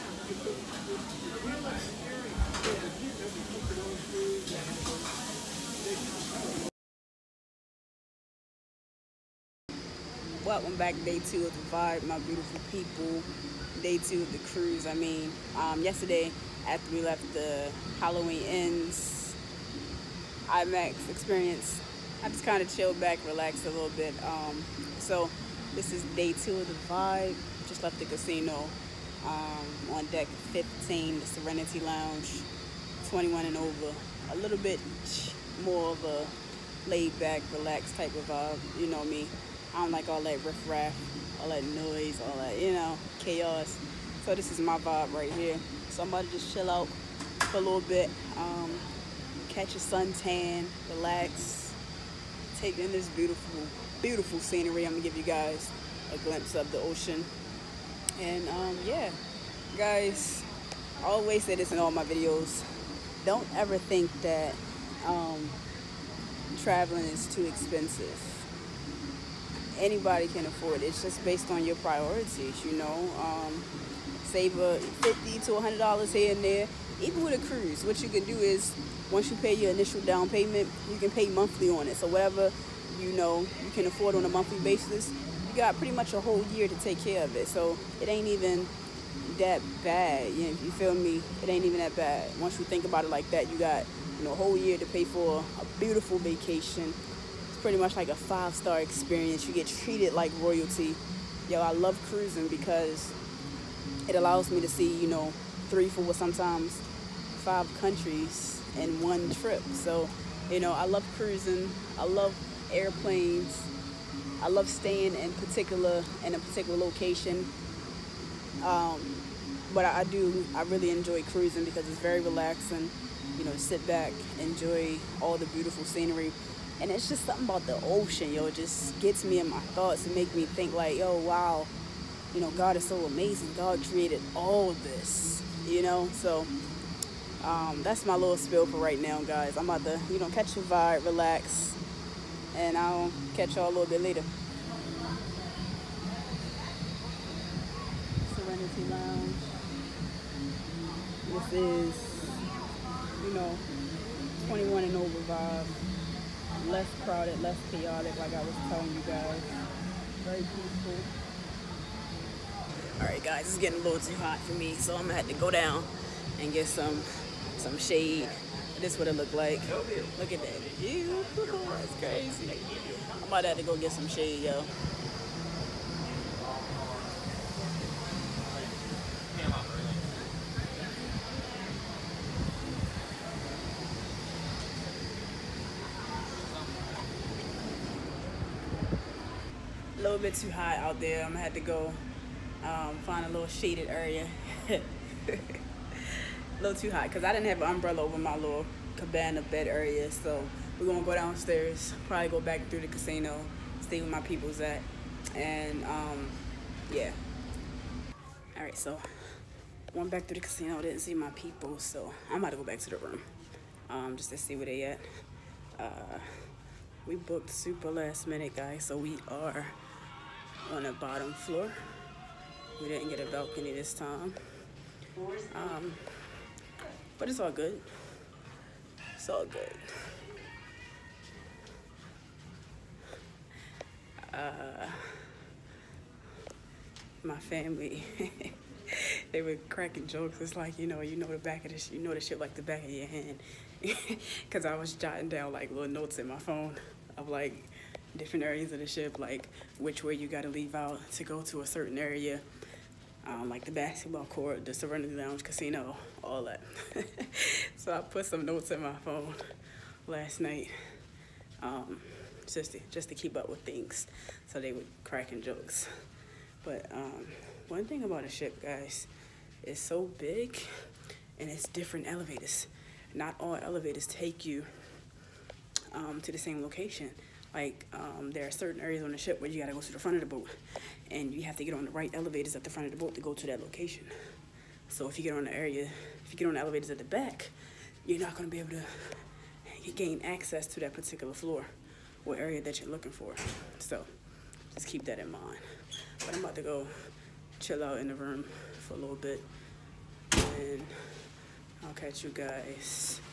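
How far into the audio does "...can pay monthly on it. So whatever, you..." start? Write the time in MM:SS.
01:20.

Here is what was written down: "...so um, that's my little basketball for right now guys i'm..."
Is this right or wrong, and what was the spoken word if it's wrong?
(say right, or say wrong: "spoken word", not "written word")
wrong: "spill", not "basketball".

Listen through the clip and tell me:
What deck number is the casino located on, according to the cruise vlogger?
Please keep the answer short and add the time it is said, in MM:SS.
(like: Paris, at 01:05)
15, at 00:30.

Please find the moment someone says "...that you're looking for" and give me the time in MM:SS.
04:52.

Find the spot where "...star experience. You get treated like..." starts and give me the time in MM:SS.
01:38.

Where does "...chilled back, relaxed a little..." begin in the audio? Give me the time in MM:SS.
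00:22.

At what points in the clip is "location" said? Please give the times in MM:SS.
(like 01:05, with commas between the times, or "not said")
01:56, 04:36, 04:43.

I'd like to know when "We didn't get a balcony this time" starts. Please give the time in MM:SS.
03:42.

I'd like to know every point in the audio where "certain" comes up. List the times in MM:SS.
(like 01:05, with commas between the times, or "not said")
04:11, 04:38.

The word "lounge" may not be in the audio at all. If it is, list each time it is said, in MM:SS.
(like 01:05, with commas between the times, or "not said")
00:31, 02:28, 04:15.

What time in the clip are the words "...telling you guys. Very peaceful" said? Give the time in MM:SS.
02:38.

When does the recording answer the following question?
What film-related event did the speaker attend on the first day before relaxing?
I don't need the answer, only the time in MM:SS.
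00:17.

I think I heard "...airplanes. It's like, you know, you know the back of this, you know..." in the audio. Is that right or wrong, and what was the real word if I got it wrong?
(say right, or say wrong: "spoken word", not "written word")
wrong: "jokes", not "airplanes".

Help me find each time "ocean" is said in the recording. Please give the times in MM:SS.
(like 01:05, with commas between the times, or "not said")
00:56, 02:07.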